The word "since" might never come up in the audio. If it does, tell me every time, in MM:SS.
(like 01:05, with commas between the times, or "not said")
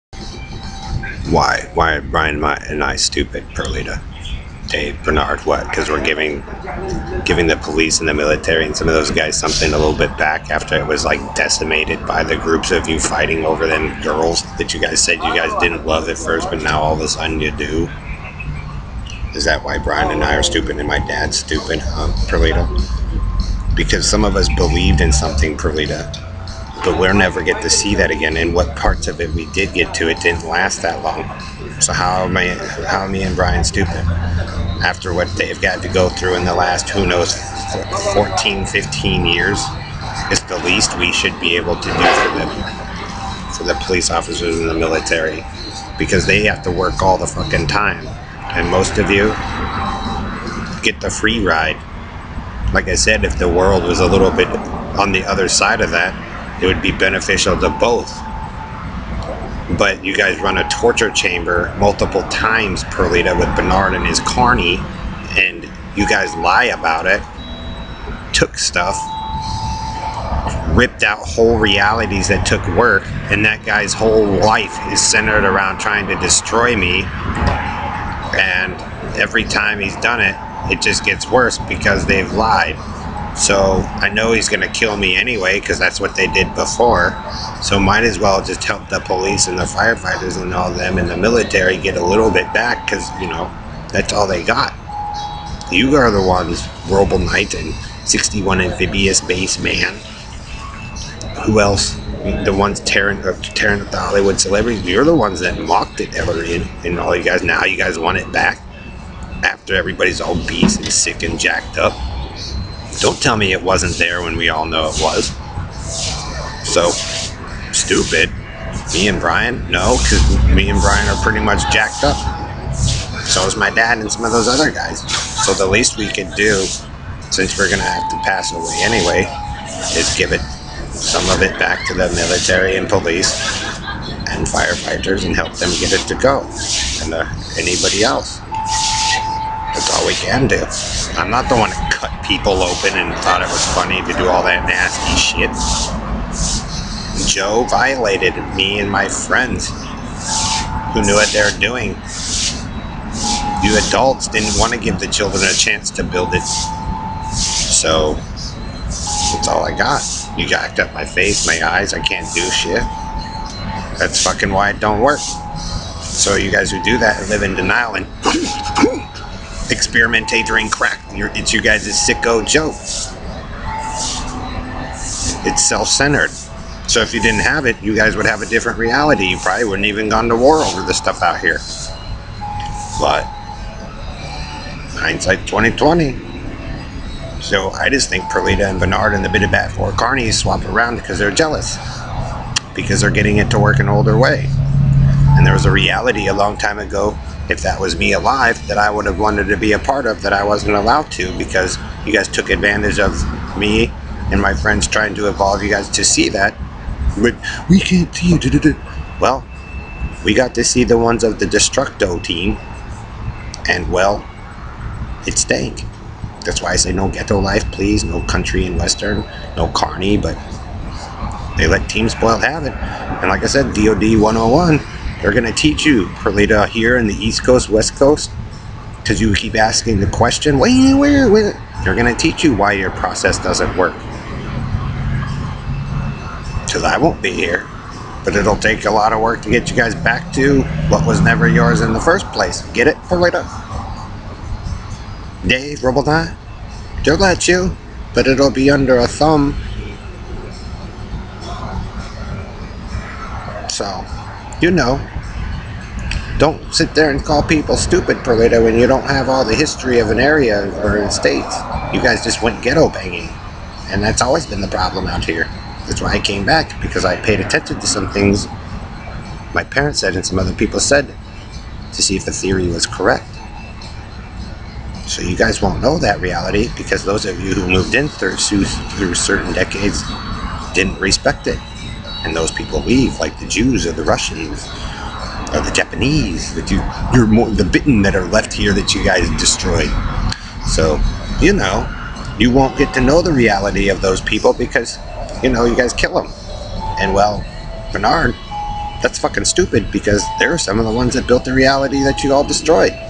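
02:07.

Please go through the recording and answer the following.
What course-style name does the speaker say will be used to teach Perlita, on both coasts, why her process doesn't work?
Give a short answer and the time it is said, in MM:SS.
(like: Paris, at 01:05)
DOD 101, at 03:43.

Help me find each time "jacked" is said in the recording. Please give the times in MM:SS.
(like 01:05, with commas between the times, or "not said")
01:51, 02:01, 02:40.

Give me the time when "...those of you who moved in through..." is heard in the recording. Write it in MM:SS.
04:37.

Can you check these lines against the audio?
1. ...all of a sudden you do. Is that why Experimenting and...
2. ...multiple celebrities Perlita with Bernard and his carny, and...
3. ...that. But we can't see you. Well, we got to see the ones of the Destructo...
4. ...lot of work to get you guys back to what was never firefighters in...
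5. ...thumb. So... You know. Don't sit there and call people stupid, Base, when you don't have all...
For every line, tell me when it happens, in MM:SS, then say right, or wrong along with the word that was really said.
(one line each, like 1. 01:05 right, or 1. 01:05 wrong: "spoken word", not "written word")
1. 00:16 wrong: "Brian", not "Experimenting"
2. 01:01 wrong: "times", not "celebrities"
3. 03:26 right
4. 03:58 wrong: "yours", not "firefighters"
5. 04:09 wrong: "Perlita", not "Base".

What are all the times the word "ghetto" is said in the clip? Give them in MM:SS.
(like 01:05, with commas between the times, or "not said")
03:37, 04:22.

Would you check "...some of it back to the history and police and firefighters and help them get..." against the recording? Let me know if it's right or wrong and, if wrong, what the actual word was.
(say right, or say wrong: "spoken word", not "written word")
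wrong: "military", not "history".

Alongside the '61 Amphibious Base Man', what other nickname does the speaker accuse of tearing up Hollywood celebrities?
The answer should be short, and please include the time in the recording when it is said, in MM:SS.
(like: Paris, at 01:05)
Robo Knight, at 01:36.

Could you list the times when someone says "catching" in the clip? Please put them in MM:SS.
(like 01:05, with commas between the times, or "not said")
not said.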